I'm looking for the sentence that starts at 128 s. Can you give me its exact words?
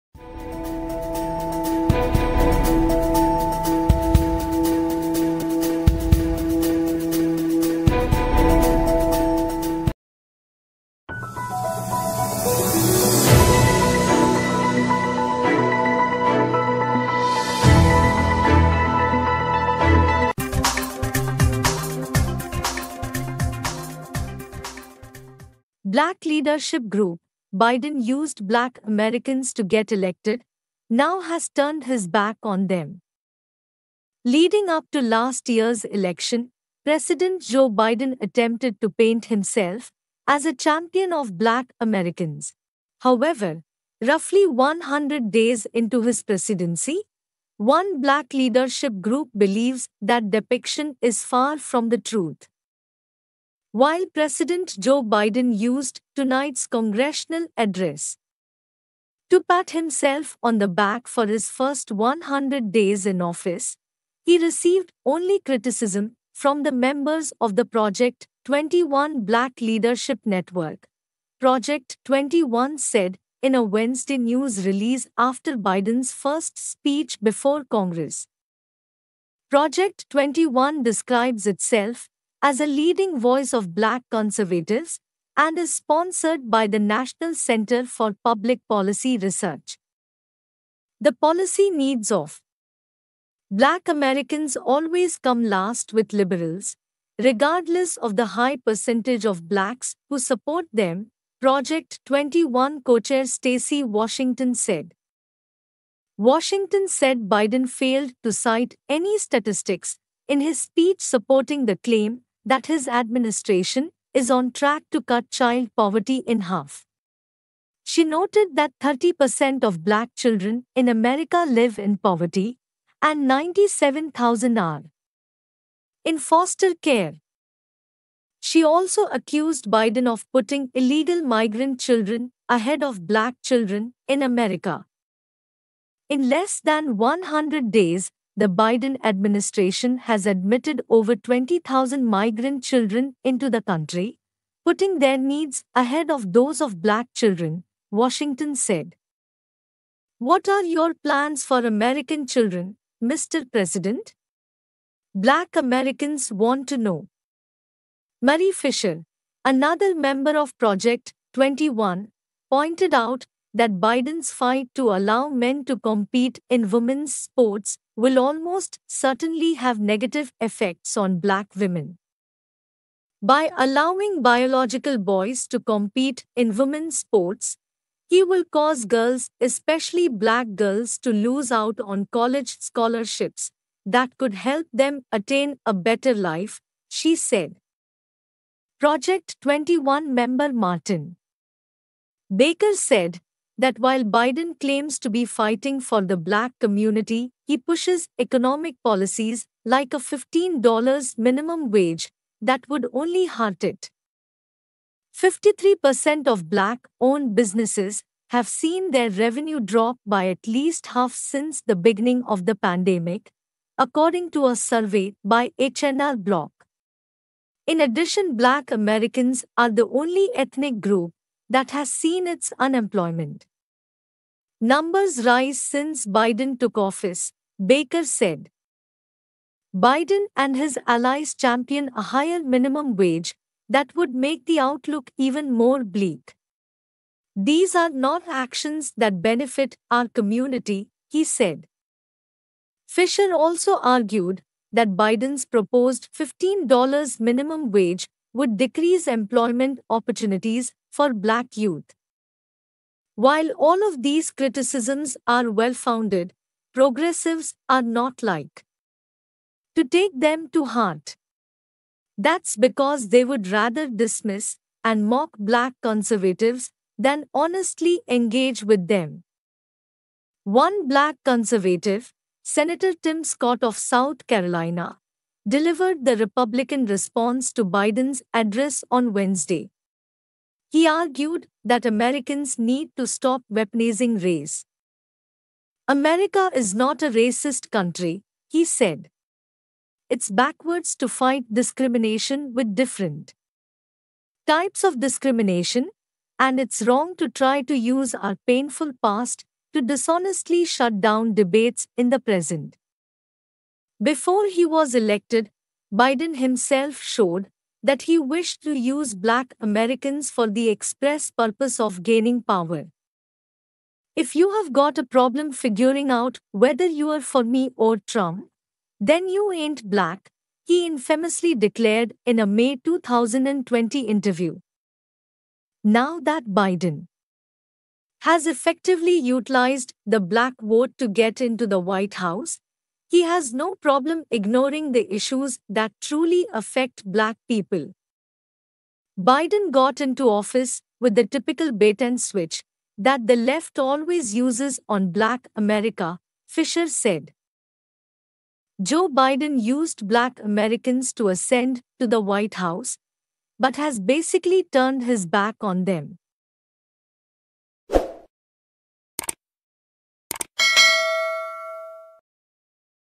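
She also accused Biden of putting illegal migrant children ahead of black children in America.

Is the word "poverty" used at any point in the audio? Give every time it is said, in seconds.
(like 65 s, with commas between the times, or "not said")
115 s, 121 s.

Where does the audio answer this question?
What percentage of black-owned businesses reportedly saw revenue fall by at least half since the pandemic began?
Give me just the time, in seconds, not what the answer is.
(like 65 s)
205 s.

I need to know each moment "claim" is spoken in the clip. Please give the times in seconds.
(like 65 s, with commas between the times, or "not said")
111 s, 194 s.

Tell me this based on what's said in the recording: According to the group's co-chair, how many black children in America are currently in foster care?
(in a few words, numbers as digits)
97,000.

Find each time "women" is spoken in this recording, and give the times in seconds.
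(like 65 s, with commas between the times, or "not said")
166 s, 171 s, 176 s.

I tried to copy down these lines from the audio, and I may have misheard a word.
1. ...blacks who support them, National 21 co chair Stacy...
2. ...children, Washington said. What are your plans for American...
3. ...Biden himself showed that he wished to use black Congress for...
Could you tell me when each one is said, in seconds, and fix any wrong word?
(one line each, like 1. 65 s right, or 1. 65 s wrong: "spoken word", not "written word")
1. 99 s wrong: "Project", not "National"
2. 147 s right
3. 305 s wrong: "Americans", not "Congress".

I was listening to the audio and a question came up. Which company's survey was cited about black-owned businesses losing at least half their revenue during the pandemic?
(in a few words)
H&R Block.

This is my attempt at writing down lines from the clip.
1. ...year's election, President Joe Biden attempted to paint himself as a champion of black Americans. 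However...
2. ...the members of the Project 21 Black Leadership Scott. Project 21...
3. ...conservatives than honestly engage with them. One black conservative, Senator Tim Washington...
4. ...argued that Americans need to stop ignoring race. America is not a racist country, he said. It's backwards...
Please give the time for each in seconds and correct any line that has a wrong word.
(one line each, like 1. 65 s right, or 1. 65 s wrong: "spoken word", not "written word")
1. 35 s right
2. 66 s wrong: "Network", not "Scott"
3. 265 s wrong: "Scott", not "Washington"
4. 280 s wrong: "weaponizing", not "ignoring".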